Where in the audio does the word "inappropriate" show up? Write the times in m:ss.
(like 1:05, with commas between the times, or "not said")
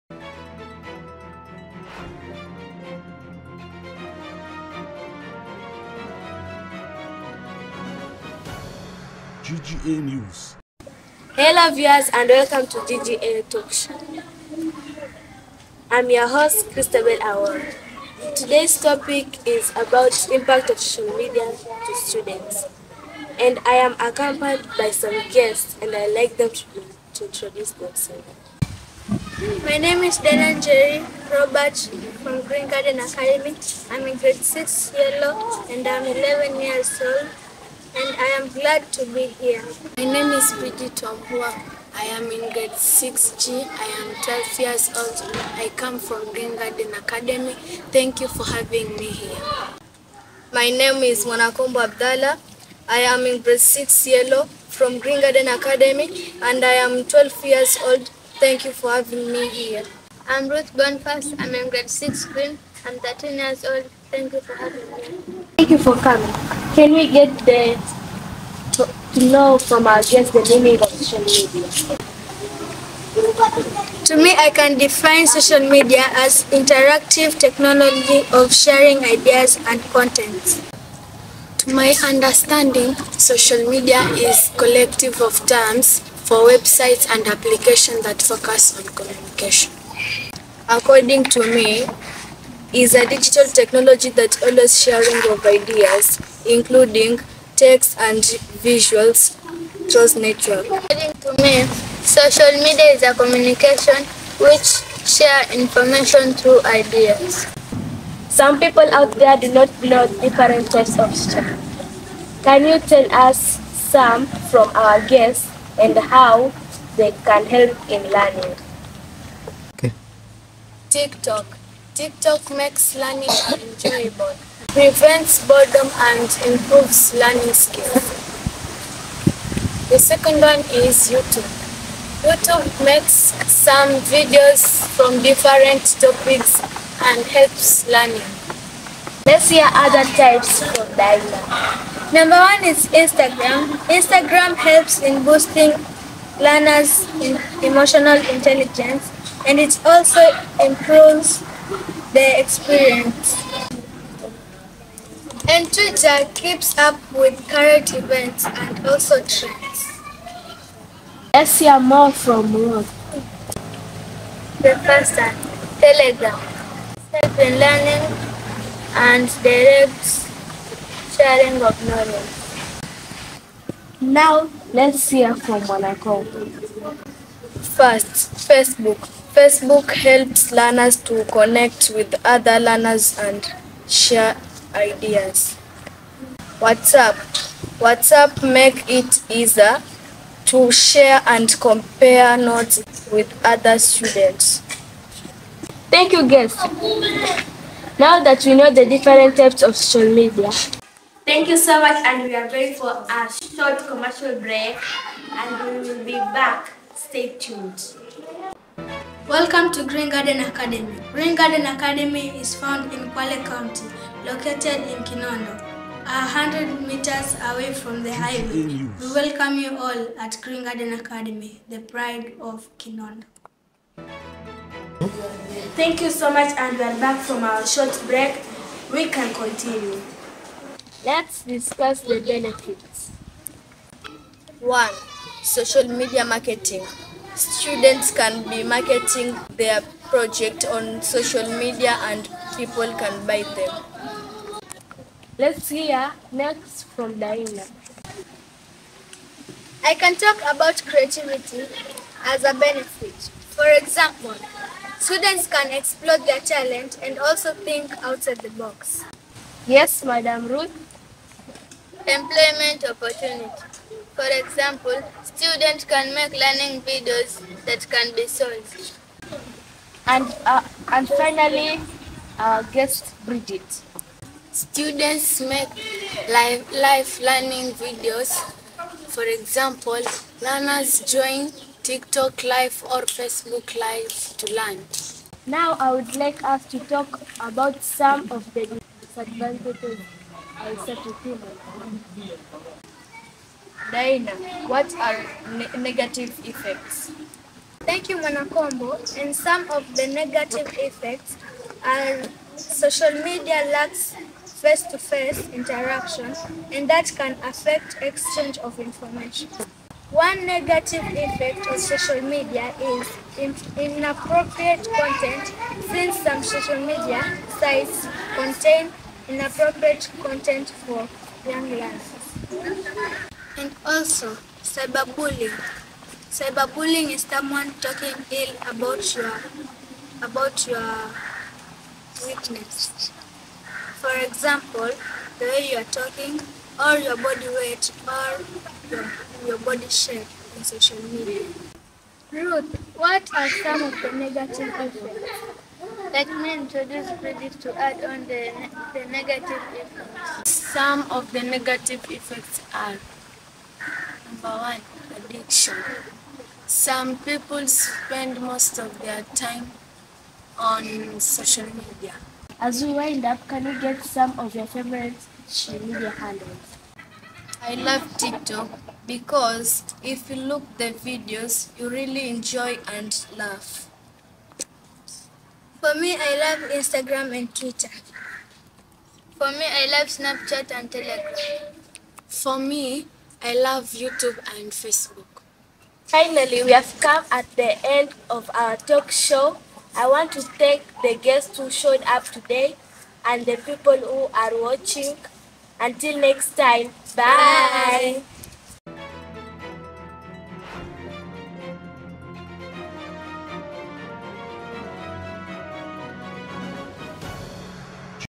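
5:13, 5:19.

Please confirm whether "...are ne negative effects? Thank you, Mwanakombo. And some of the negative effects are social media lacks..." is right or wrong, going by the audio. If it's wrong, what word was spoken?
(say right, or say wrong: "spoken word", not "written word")
right.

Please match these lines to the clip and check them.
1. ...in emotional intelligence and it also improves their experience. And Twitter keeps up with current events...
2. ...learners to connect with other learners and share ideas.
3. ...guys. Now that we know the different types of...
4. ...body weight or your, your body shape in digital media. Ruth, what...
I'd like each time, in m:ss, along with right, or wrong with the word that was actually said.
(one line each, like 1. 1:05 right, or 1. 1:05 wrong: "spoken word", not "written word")
1. 2:27 right
2. 3:00 right
3. 3:16 right
4. 5:37 wrong: "social", not "digital".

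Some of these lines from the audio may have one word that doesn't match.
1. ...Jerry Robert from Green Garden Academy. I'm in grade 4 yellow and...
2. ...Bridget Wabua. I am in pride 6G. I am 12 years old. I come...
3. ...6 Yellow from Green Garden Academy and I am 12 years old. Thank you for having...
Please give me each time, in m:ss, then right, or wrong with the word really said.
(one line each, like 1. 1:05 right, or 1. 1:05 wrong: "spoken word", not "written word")
1. 0:30 wrong: "6", not "4"
2. 0:40 wrong: "grade", not "pride"
3. 0:53 right.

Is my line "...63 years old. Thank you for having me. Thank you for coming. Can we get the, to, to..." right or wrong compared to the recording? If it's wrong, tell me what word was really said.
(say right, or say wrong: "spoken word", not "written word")
wrong: "13", not "63".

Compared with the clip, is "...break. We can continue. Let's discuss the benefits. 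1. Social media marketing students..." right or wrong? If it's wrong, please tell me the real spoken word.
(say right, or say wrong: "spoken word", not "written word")
right.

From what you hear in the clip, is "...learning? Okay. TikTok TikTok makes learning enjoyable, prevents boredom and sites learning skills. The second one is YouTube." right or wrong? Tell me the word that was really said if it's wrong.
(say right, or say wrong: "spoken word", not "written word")
wrong: "improves", not "sites".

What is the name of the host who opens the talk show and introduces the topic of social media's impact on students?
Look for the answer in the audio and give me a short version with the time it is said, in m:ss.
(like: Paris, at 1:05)
Christabel Award, at 0:16.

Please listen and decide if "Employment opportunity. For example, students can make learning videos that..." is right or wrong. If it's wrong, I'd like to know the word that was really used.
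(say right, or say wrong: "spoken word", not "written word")
right.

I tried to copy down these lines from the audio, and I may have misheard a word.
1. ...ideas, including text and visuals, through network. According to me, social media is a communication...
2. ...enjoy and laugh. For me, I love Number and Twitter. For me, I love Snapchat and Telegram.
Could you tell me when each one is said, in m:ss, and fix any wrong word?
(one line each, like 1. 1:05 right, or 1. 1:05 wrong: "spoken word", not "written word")
1. 1:35 right
2. 6:12 wrong: "Instagram", not "Number".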